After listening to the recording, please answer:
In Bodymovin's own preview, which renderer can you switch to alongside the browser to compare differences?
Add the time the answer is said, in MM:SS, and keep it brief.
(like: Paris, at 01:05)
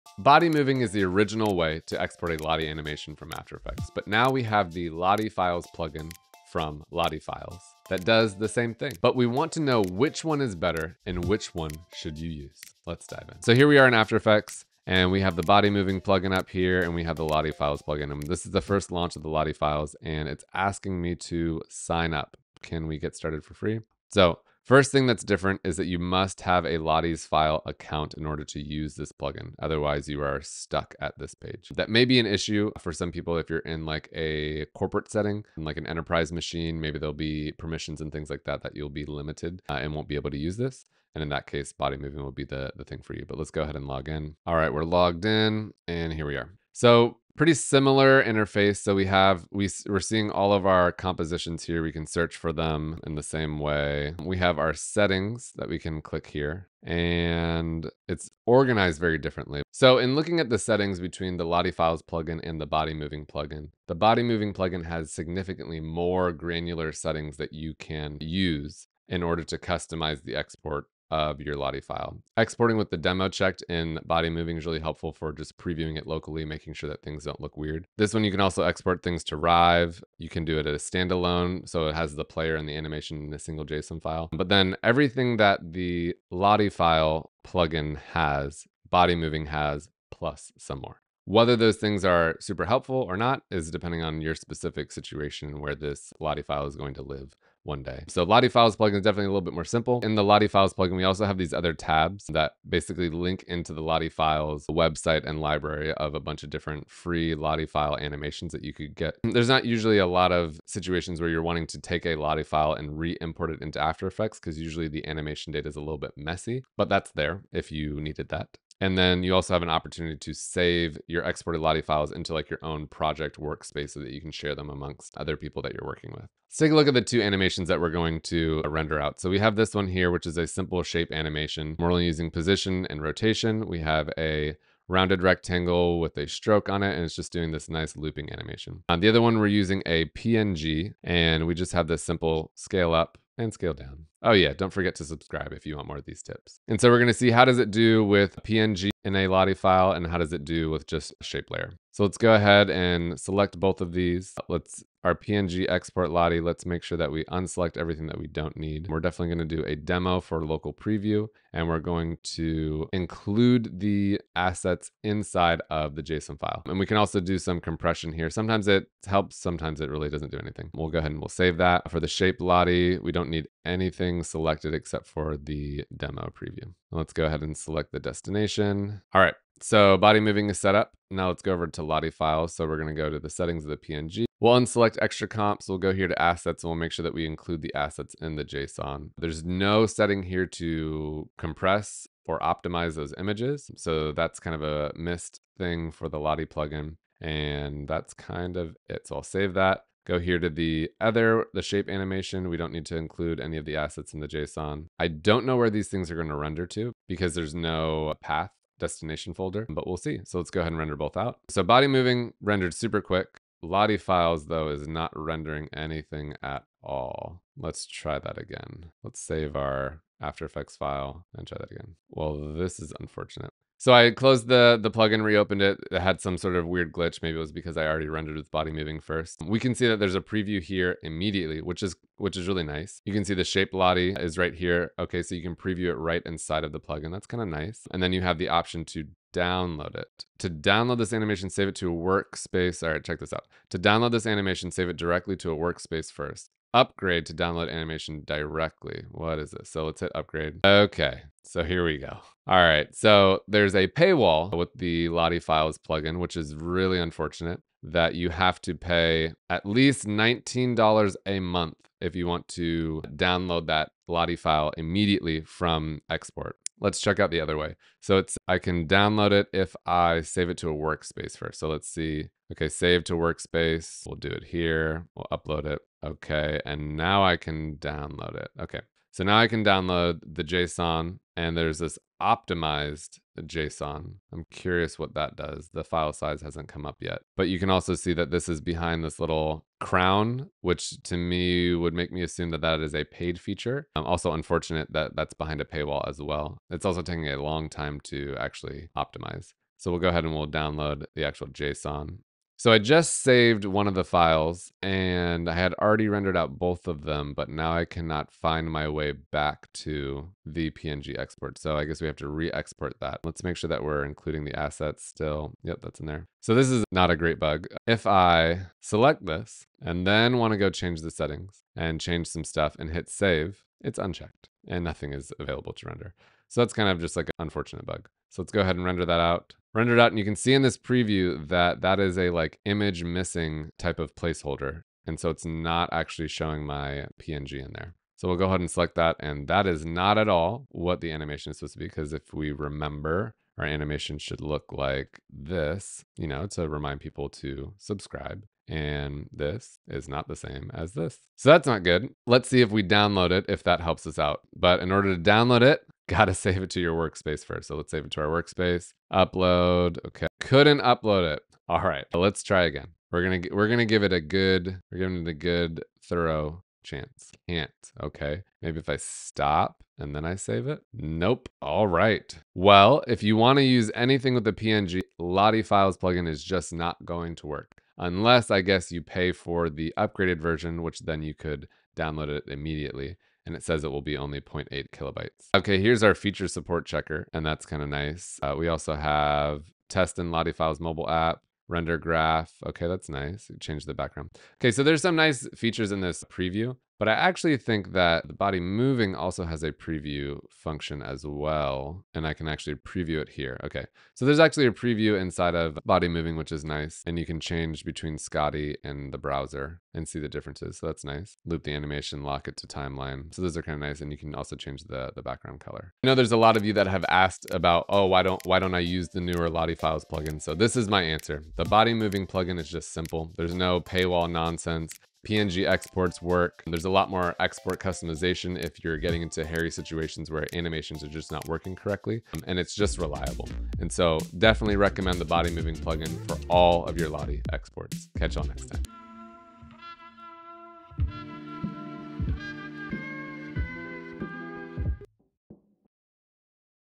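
Skottie, at 06:48.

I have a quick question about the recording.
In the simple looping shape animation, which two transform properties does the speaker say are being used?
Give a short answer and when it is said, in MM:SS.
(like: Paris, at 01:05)
Position and rotation, at 02:12.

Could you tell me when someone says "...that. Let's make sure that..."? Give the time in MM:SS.
05:12.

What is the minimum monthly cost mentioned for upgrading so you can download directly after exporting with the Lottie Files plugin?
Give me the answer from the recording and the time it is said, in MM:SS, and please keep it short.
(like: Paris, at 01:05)
$19, at 04:20.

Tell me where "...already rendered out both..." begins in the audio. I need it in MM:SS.
05:05.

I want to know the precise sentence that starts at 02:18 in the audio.
On uh, the other one, we're using a PNG and we just have this simple scale up and scale down.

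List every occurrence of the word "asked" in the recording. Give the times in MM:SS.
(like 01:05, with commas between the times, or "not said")
06:57.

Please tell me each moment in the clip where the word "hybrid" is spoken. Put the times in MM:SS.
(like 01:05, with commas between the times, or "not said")
not said.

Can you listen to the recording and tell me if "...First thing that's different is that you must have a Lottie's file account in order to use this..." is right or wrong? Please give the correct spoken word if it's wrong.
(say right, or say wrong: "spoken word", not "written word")
right.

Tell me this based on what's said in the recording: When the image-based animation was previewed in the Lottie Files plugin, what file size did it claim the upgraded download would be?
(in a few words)
0.8 kilobytes.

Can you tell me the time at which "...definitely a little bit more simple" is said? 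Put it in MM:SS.
01:39.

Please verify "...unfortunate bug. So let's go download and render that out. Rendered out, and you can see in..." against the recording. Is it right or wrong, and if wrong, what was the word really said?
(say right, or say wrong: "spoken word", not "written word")
wrong: "ahead", not "download".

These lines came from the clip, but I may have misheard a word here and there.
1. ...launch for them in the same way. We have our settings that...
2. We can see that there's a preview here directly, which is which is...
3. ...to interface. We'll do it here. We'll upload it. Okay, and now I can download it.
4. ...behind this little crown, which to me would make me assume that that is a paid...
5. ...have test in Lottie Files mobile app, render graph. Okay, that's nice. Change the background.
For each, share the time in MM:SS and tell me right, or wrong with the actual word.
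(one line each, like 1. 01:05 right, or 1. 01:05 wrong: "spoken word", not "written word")
1. 00:52 wrong: "search", not "launch"
2. 03:49 wrong: "immediately", not "directly"
3. 04:33 wrong: "workspace", not "interface"
4. 04:48 right
5. 06:28 right.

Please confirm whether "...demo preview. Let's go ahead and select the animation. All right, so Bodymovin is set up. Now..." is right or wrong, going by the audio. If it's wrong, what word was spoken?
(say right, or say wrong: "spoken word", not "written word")
wrong: "destination", not "animation".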